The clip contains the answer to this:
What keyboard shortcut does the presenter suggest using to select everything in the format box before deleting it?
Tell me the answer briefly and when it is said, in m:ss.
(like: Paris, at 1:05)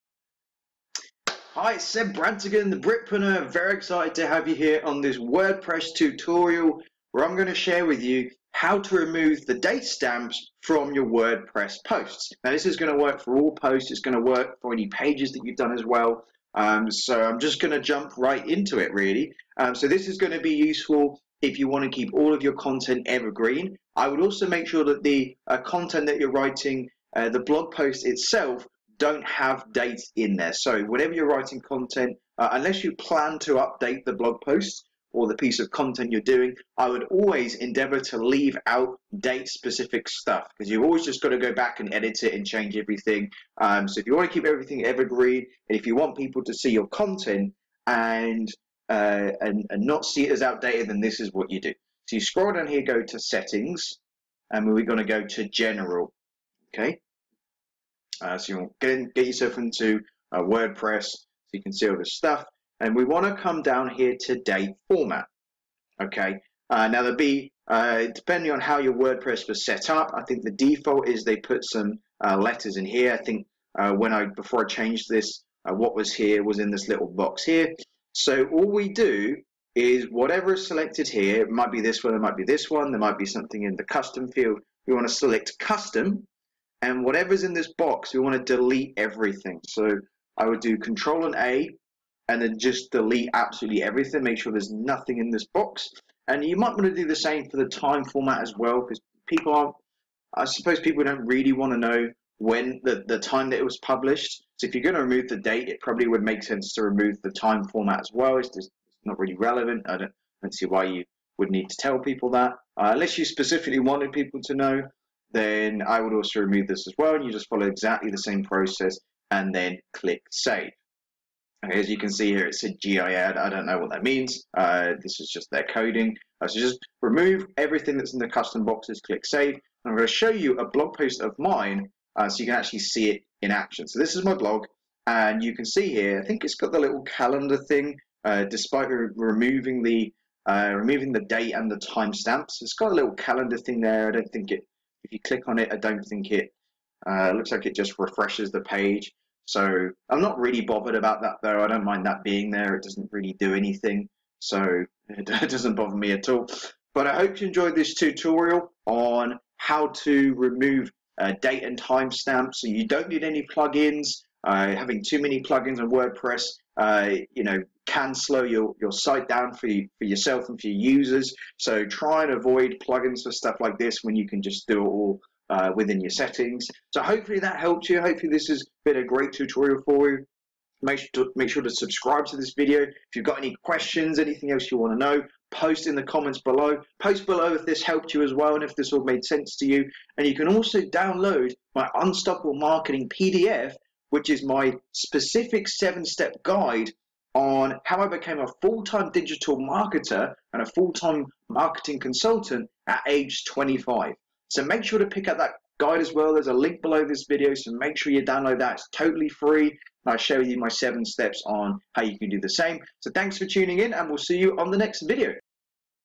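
Control and A, at 1:30.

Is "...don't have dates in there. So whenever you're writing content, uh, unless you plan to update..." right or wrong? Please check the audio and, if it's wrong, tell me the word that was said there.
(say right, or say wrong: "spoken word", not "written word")
right.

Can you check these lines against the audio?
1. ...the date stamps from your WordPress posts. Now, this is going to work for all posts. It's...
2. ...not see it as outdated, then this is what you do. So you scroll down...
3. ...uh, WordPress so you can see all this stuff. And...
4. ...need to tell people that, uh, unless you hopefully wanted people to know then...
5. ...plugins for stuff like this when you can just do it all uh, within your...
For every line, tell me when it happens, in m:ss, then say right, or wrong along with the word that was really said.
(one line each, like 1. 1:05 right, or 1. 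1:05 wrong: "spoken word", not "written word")
1. 0:09 right
2. 0:49 right
3. 1:00 right
4. 1:51 wrong: "specifically", not "hopefully"
5. 2:52 right.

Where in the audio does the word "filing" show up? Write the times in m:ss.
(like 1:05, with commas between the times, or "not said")
not said.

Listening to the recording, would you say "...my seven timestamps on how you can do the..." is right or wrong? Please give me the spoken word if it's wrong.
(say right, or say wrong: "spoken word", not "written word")
wrong: "steps", not "timestamps".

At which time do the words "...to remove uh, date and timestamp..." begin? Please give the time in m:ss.
2:40.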